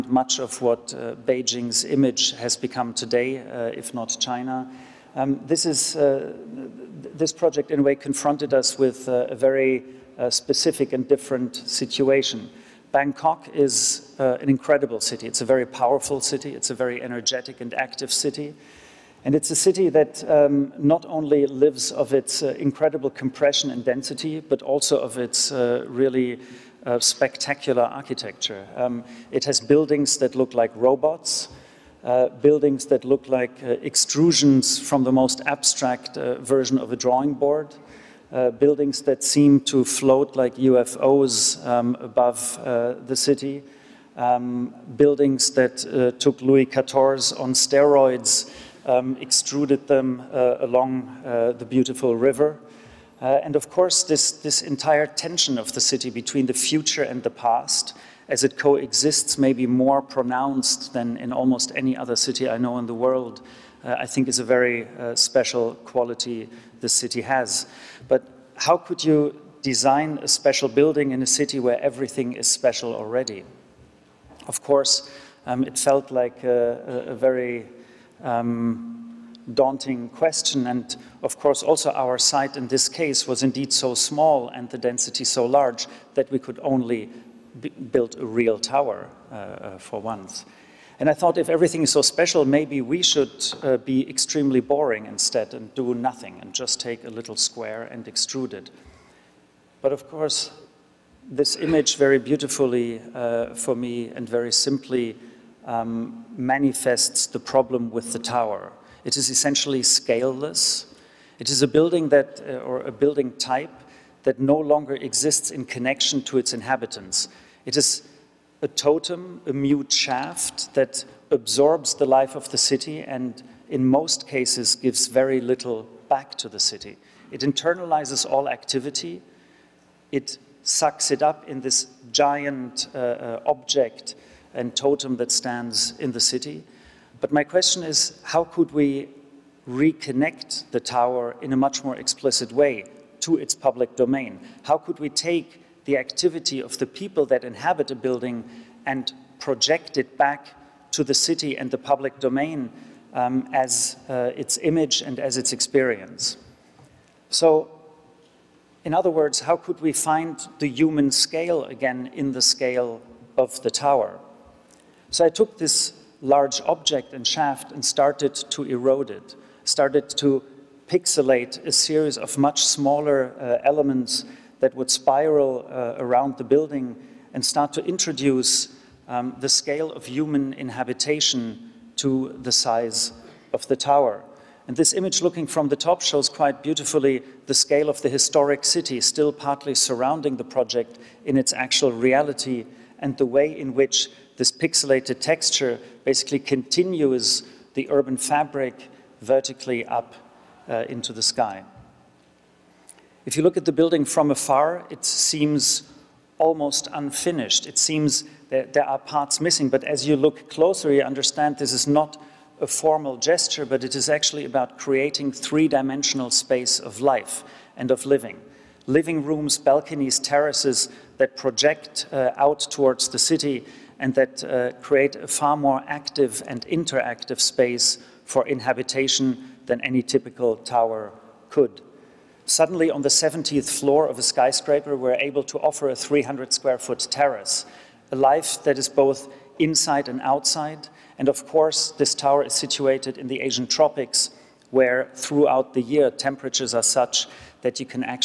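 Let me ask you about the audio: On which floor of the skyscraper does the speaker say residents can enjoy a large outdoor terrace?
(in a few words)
70th floor.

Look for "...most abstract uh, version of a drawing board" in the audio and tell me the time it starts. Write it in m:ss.
0:35.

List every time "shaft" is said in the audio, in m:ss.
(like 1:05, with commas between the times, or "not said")
1:59, 2:47.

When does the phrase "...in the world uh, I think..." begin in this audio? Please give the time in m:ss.
1:02.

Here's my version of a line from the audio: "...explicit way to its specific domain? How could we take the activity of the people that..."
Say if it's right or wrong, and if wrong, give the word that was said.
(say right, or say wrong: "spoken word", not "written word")
wrong: "public", not "specific".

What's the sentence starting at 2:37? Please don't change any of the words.
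So, in other words, how could we find the human scale again in the scale of the tower?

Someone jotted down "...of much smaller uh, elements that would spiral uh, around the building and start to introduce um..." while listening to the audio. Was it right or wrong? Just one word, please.
right.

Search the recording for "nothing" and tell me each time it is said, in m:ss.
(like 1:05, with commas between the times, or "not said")
1:35.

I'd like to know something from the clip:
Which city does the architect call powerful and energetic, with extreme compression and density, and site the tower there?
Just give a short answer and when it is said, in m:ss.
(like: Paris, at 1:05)
Bangkok, at 0:12.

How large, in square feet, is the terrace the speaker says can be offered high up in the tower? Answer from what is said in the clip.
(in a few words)
300 square feet.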